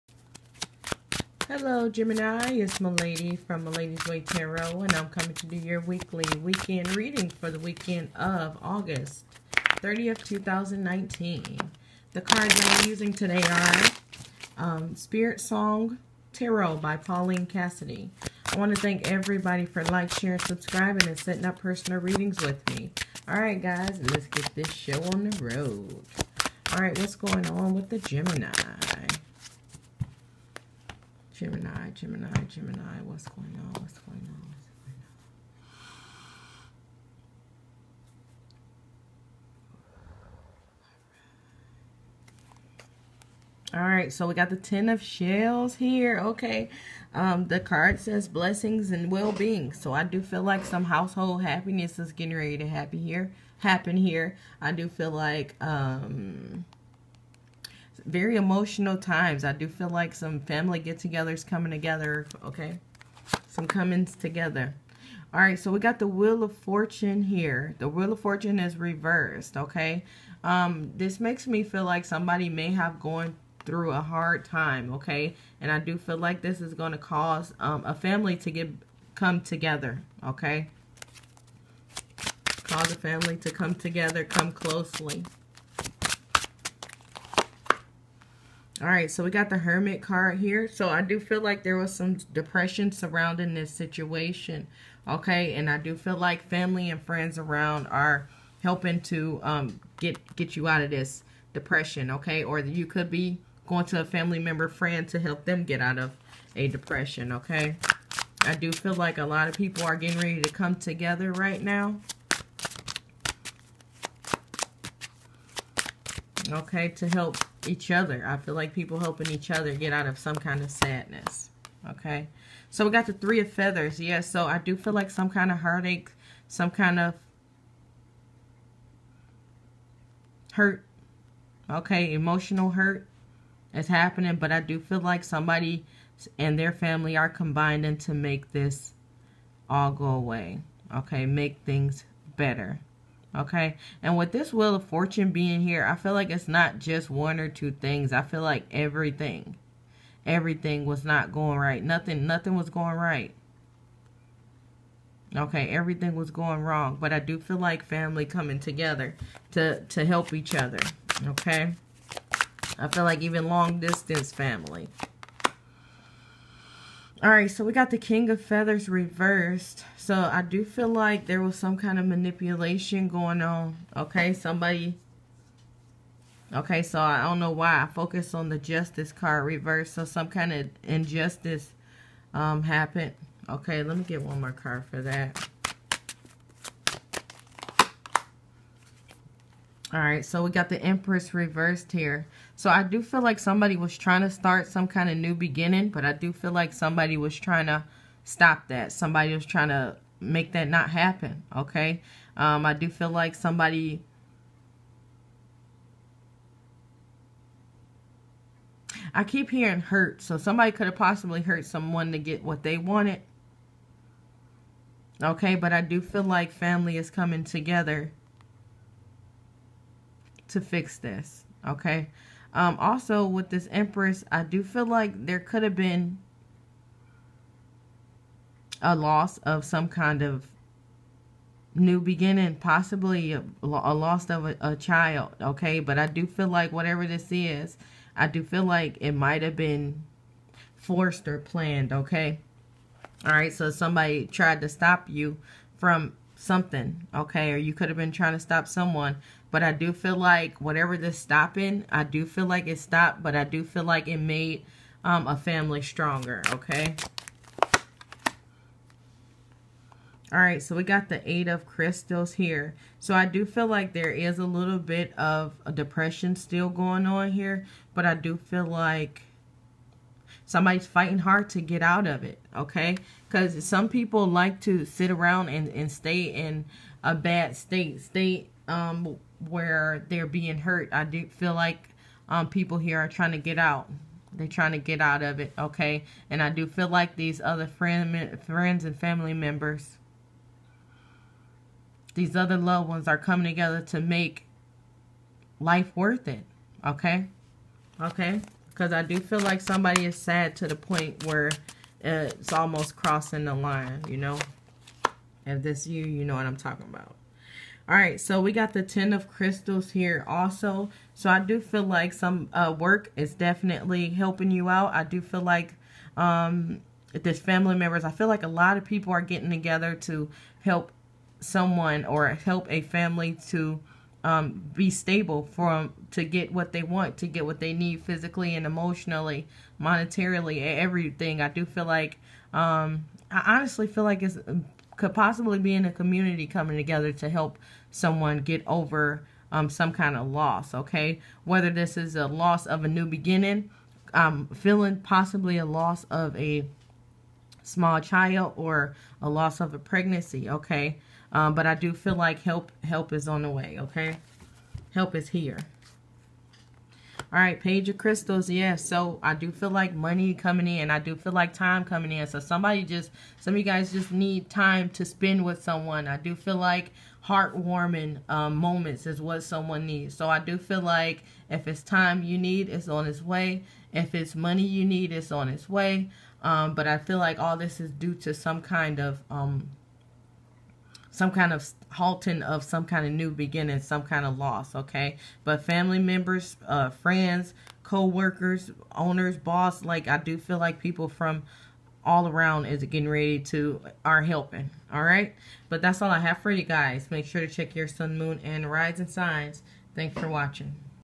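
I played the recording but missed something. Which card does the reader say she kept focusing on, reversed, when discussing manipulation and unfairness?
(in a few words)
Justice.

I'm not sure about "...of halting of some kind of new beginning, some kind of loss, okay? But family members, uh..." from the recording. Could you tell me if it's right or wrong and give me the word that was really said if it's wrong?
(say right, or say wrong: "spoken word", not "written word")
right.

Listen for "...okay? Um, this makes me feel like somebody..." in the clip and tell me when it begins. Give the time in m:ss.
1:09.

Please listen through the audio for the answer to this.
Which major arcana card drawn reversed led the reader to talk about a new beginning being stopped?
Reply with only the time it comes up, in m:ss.
3:10.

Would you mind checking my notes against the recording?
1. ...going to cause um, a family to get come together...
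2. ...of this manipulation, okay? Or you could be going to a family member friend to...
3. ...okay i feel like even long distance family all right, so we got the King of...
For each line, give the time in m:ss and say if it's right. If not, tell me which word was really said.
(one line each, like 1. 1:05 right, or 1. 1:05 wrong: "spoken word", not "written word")
1. 1:16 right
2. 1:40 wrong: "depression", not "manipulation"
3. 2:41 right.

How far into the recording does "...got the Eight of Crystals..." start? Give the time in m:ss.
4:20.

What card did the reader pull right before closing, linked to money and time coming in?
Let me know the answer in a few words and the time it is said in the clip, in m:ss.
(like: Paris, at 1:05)
Page of Crystals, at 5:57.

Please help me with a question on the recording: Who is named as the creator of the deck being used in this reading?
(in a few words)
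Paulina Cassidy.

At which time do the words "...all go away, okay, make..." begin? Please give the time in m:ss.
2:19.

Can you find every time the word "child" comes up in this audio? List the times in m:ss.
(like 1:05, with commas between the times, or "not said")
3:54, 5:47.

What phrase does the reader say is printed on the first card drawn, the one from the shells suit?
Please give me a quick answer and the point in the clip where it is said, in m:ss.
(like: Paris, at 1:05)
blessings and well-being, at 0:48.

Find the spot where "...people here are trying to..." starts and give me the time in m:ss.
4:42.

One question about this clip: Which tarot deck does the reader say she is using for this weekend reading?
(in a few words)
Spirit Song Tarot.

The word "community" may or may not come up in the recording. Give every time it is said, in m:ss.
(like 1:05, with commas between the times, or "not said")
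5:35.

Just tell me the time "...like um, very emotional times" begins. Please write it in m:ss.
0:55.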